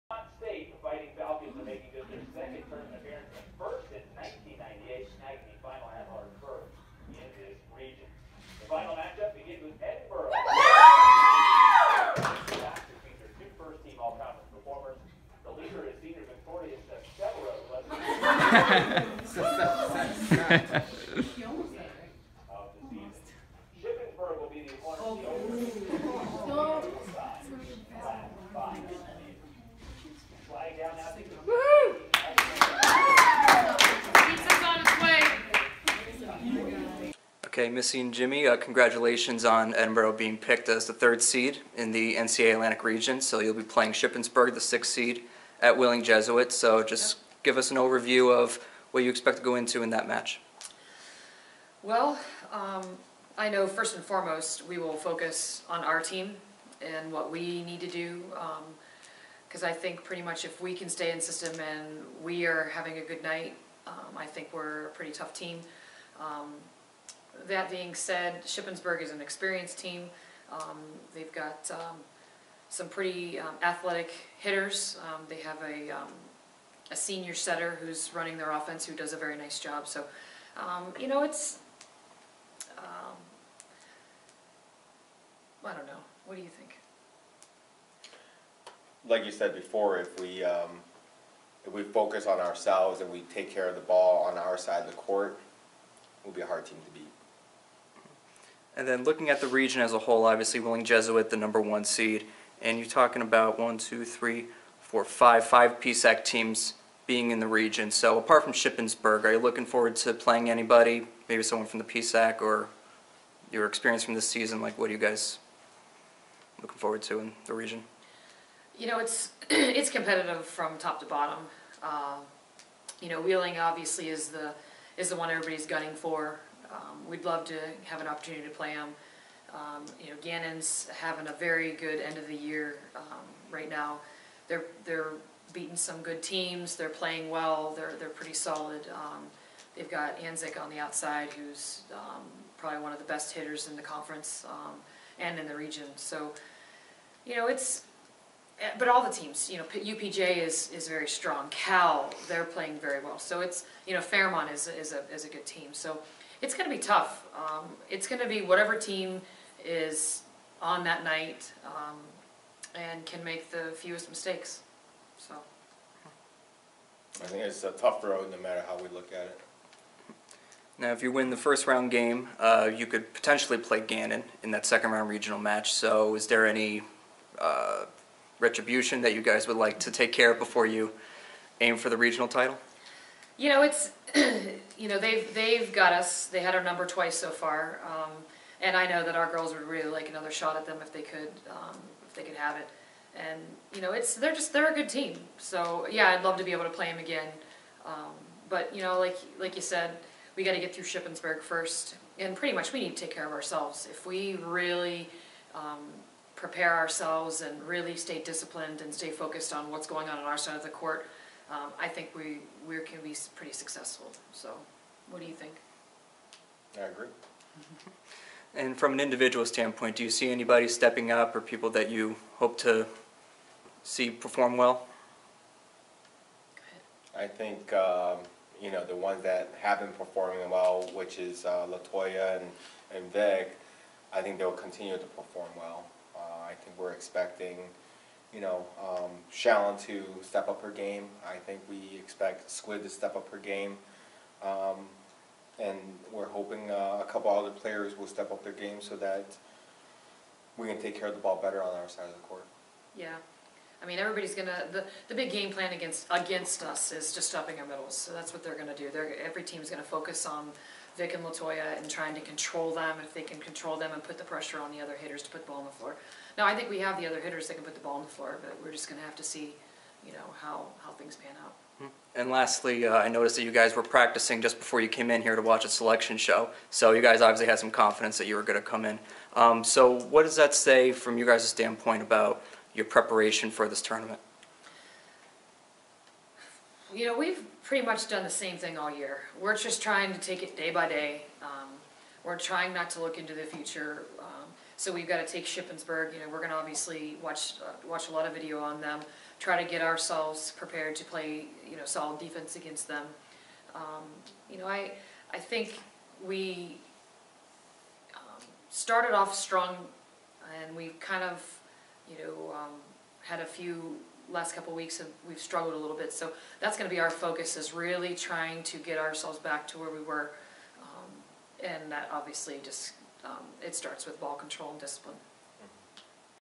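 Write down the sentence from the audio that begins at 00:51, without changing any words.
Well, um, I know first and foremost we will focus on our team and what we need to do.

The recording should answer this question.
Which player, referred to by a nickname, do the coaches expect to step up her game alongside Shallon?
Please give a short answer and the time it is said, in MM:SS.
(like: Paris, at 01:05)
Squid, at 04:02.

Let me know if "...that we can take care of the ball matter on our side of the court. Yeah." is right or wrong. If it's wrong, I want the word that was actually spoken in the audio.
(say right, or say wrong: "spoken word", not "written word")
wrong: "better", not "matter".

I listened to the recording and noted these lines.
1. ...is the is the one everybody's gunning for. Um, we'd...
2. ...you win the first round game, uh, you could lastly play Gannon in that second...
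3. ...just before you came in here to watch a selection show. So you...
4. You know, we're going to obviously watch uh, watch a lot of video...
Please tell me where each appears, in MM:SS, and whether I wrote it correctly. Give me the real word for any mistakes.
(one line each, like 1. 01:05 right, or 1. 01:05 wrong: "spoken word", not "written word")
1. 02:04 right
2. 02:51 wrong: "potentially", not "lastly"
3. 04:34 right
4. 04:56 right.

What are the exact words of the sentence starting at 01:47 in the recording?
So apart from Shippensburg, are you looking forward to playing anybody?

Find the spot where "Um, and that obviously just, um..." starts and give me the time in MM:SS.
05:20.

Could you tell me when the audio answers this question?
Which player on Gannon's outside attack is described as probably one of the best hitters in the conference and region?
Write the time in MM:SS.
02:20.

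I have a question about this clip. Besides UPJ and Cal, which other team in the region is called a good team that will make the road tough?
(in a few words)
Fairmont.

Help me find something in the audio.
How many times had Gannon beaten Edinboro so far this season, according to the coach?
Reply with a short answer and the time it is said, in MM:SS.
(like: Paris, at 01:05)
2, at 03:06.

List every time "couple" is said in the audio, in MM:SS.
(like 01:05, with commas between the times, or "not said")
04:07, 05:14.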